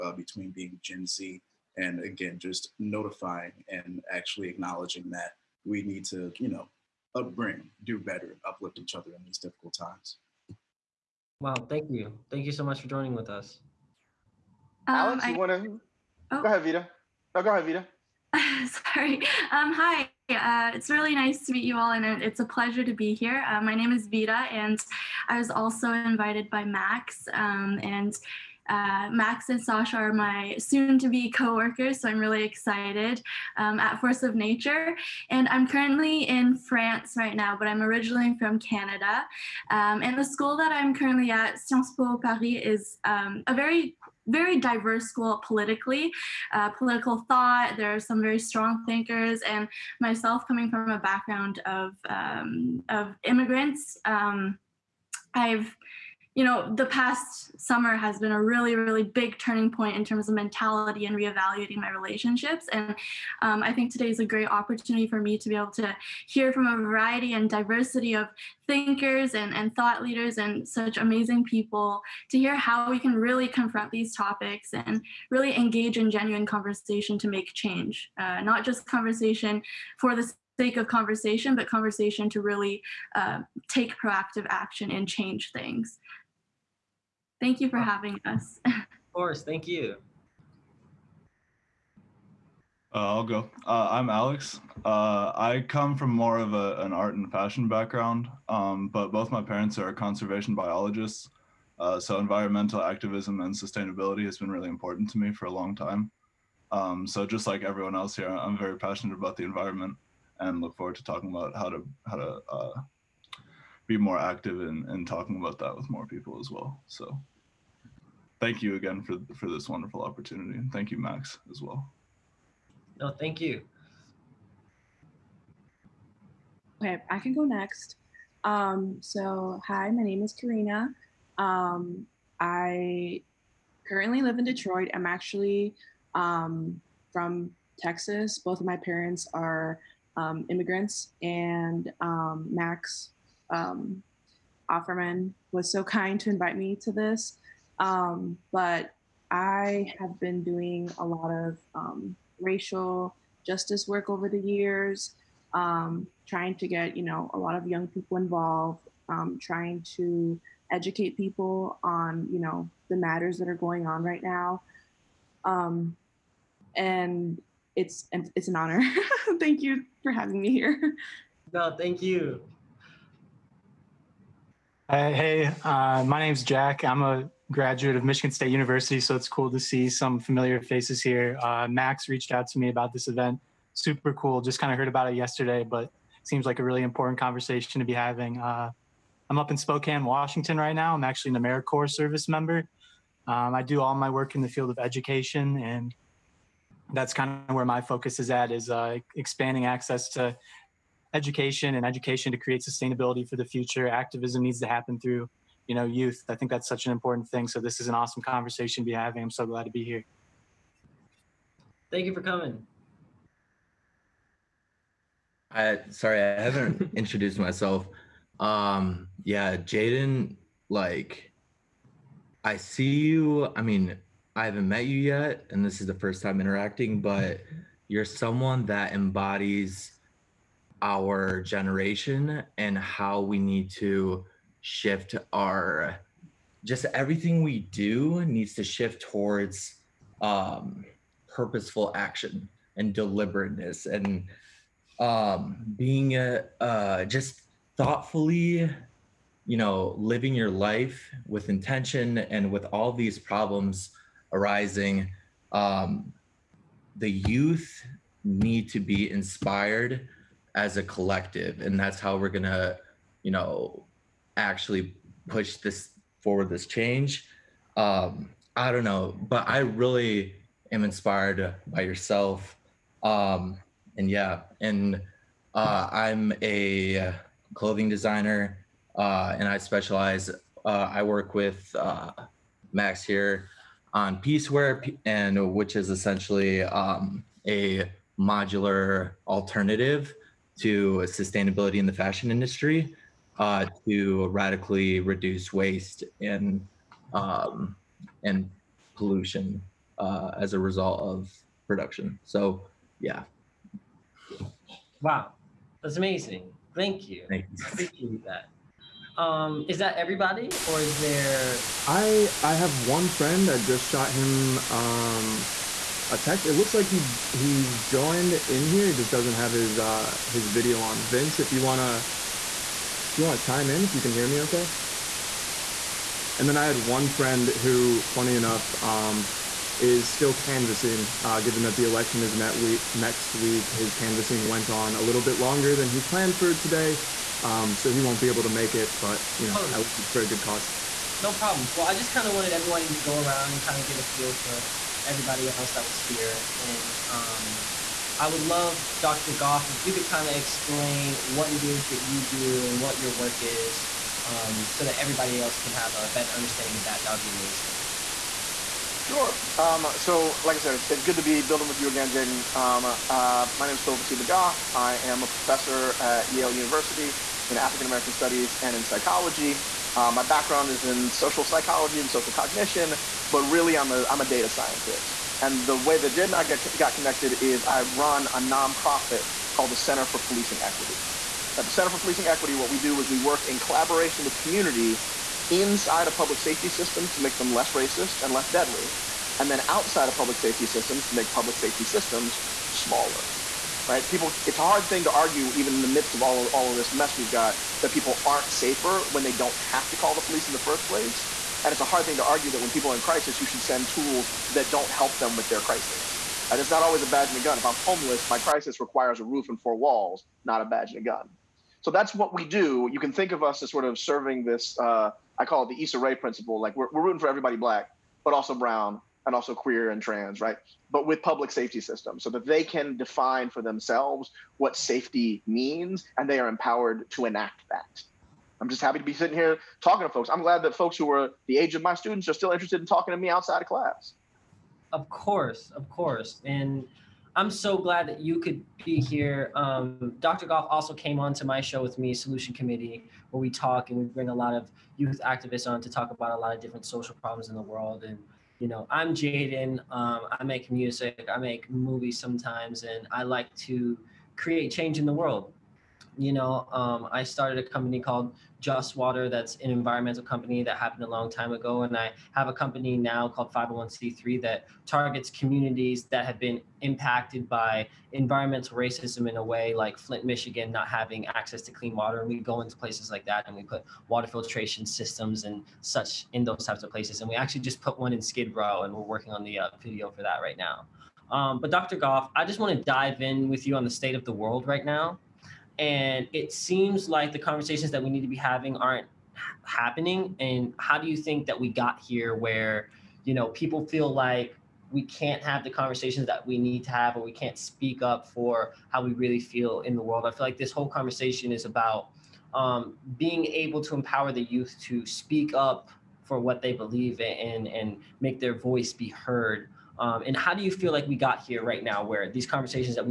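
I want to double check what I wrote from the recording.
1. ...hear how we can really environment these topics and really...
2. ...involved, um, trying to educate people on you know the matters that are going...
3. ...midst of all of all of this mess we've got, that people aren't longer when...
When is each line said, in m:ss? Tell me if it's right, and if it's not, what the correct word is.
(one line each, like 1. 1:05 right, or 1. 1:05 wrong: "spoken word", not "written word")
1. 1:12 wrong: "confront", not "environment"
2. 2:38 right
3. 6:35 wrong: "safer", not "longer".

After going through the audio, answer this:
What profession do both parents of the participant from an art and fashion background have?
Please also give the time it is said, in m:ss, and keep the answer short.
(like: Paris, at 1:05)
Conservation biologists, at 1:39.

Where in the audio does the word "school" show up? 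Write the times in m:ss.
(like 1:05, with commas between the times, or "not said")
0:40, 0:45.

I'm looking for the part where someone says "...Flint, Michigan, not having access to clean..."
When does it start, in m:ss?
7:49.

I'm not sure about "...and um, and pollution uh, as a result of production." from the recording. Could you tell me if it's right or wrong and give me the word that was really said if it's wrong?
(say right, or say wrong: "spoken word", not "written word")
right.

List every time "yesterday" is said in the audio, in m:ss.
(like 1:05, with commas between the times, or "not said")
3:05.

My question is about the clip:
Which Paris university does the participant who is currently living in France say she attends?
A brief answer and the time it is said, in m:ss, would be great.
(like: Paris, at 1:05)
Sciences Po Paris, at 0:41.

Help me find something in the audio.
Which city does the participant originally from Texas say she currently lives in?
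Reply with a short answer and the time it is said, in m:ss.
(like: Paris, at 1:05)
Detroit, at 2:14.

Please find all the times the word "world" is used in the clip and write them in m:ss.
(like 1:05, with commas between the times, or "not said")
7:27, 7:35, 8:04, 8:20.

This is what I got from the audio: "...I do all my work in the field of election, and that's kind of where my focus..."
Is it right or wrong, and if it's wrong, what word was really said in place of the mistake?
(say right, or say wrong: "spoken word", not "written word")
wrong: "education", not "election".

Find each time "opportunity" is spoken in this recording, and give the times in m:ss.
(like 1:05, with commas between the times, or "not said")
1:04, 2:00.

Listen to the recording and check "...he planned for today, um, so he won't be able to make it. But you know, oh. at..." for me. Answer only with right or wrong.
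right.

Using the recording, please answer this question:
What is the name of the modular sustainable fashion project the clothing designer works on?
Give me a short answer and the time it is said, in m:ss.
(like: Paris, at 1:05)
Piecewear, at 4:44.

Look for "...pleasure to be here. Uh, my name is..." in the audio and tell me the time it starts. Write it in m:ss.
0:22.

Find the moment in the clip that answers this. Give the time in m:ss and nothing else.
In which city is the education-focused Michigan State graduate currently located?
3:09.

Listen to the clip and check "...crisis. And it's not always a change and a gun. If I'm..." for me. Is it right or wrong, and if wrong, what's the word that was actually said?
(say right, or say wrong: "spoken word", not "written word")
wrong: "badge", not "change".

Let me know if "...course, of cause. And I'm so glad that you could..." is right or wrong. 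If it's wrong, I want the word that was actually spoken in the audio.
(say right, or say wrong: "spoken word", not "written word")
wrong: "course", not "cause".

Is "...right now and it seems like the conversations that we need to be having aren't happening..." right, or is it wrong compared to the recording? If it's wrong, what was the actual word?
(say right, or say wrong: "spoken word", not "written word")
right.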